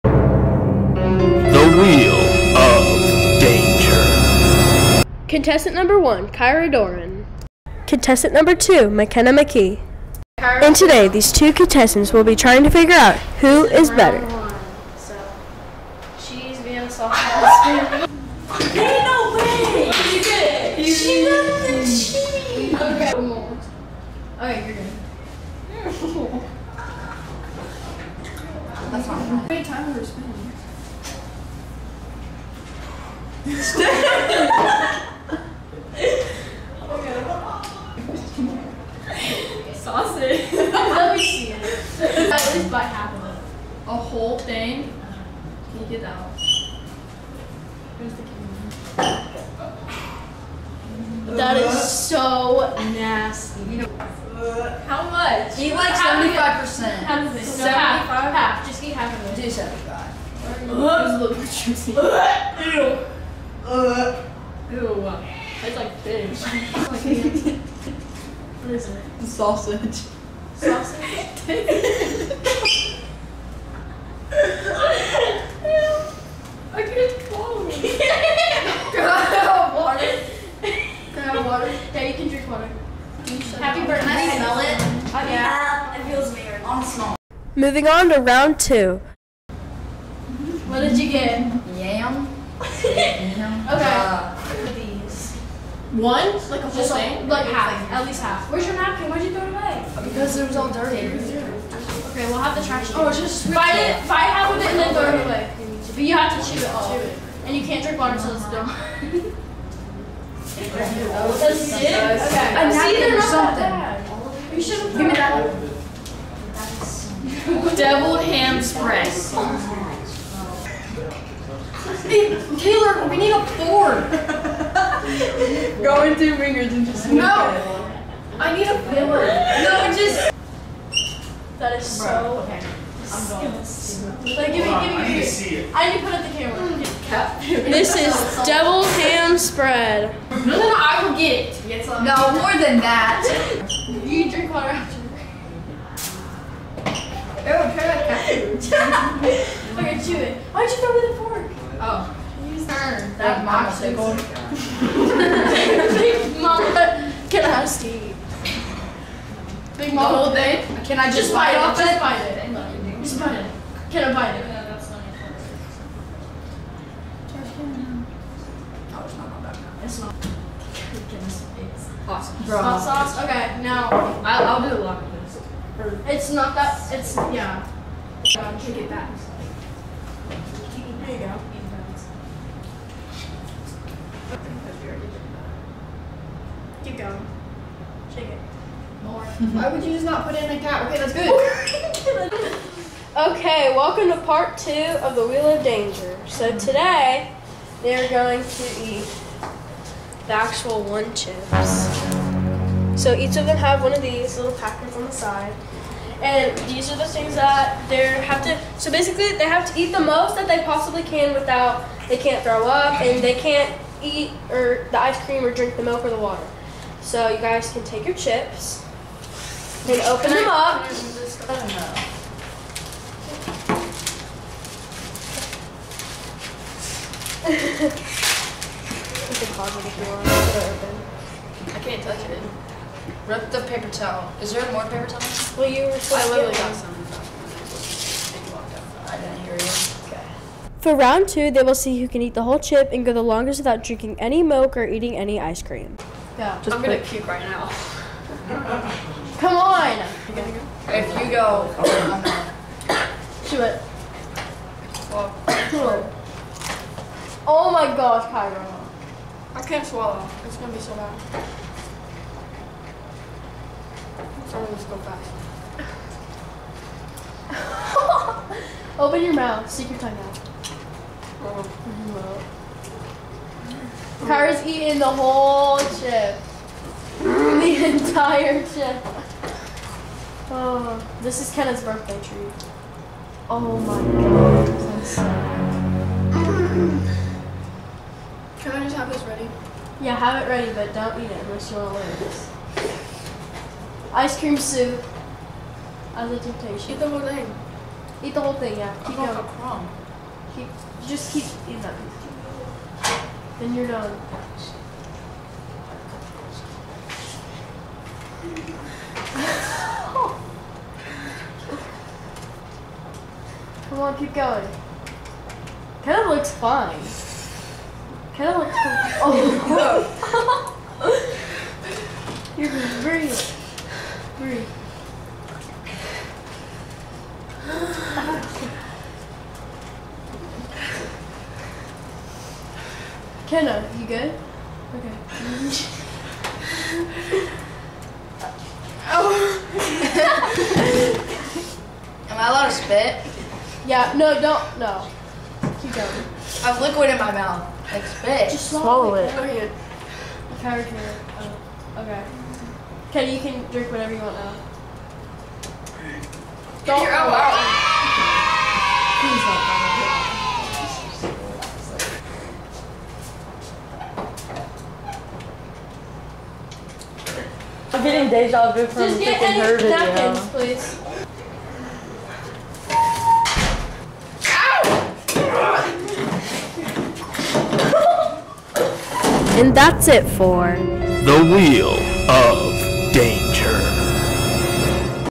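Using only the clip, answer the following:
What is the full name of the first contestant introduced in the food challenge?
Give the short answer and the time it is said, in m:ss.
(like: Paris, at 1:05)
Kyra Doran, at 0:06.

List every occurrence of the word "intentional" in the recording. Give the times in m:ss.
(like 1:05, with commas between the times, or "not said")
not said.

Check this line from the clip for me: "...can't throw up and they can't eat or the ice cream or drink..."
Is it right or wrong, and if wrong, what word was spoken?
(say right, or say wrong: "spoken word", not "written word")
right.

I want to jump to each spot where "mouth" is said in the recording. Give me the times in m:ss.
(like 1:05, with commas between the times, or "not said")
4:29, 5:47.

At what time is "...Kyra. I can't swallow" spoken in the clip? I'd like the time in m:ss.
4:18.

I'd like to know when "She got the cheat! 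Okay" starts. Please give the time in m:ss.
0:20.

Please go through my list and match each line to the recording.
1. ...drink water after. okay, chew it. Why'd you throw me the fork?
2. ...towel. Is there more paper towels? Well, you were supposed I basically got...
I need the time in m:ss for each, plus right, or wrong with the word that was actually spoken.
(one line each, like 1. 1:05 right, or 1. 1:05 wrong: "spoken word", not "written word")
1. 2:24 right
2. 3:53 wrong: "literally", not "basically".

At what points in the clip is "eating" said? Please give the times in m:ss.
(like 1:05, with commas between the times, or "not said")
4:04, 4:34, 5:01.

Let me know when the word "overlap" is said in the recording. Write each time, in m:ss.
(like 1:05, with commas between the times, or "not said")
not said.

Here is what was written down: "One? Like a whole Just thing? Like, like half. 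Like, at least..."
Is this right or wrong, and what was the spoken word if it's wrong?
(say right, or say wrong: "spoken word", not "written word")
right.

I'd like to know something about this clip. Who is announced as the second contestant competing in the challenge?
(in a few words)
McKenna McKee.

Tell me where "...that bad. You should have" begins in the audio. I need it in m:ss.
1:53.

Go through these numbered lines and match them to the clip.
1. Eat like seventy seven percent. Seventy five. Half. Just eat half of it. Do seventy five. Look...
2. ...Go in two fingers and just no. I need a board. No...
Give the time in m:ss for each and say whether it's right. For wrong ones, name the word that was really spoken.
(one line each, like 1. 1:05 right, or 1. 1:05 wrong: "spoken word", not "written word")
1. 0:55 wrong: "five", not "seven"
2. 2:05 right.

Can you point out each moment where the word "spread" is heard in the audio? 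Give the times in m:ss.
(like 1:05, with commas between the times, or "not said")
1:58, 2:19.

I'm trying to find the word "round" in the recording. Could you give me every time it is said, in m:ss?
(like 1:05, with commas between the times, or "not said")
1:28, 4:00.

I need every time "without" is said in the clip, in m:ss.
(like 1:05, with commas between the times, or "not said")
3:31, 4:03.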